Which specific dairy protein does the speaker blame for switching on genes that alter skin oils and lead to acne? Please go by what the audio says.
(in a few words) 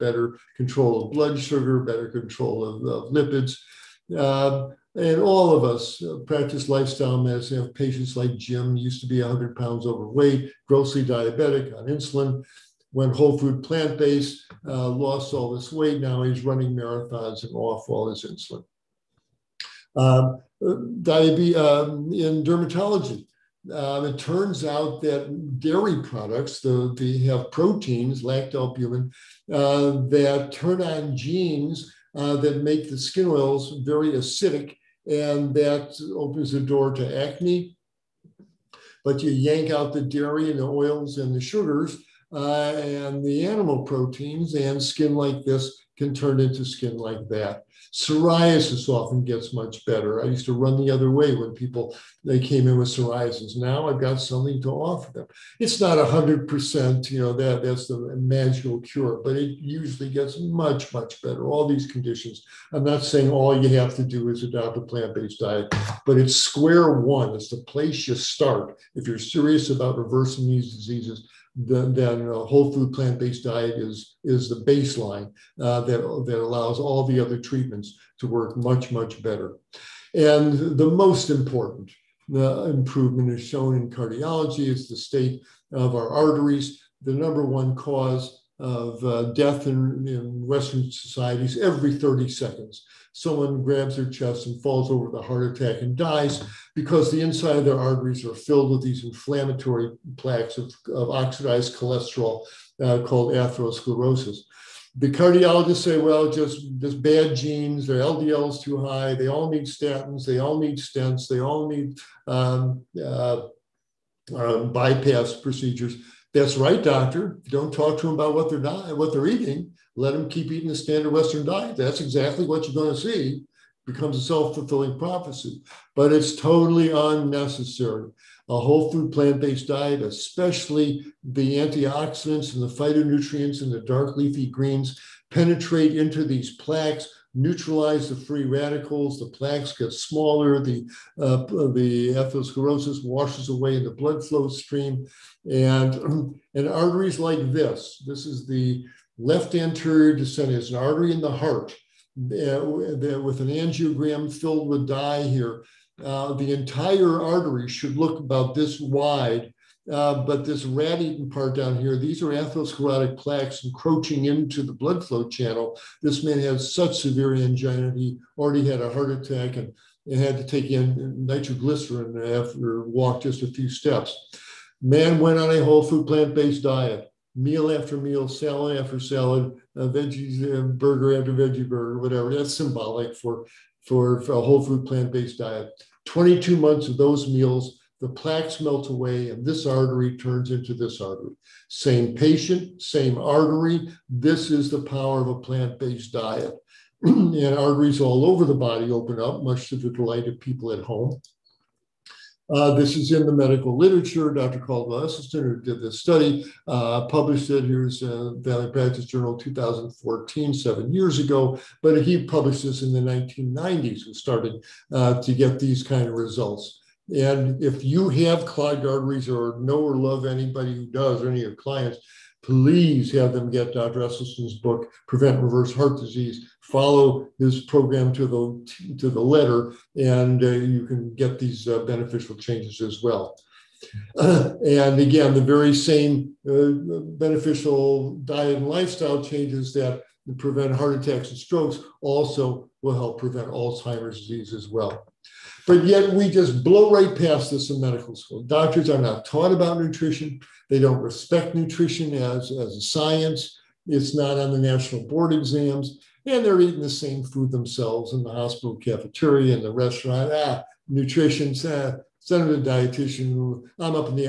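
lactalbumin.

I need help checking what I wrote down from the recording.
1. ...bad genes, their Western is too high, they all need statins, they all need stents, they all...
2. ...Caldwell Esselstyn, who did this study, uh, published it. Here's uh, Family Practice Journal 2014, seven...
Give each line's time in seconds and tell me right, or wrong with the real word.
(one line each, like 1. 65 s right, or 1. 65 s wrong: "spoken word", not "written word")
1. 107 s wrong: "LDL", not "Western"
2. 204 s right.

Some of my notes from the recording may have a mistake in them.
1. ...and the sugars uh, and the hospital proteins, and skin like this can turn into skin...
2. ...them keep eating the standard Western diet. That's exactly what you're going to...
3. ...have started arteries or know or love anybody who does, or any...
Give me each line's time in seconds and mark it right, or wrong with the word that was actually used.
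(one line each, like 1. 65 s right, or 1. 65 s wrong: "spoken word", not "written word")
1. 41 s wrong: "animal", not "hospital"
2. 120 s right
3. 218 s wrong: "clogged", not "started".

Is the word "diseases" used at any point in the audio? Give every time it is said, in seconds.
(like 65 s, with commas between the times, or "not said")
70 s, 225 s, 244 s.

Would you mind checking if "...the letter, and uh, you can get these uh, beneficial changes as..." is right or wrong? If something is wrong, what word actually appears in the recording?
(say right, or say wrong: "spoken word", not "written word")
right.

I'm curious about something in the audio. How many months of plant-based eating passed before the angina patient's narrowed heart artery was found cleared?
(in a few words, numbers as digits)
22.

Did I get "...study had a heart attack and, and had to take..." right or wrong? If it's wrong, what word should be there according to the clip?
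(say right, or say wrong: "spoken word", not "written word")
wrong: "already", not "study".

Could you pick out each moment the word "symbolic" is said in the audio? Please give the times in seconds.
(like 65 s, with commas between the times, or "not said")
182 s.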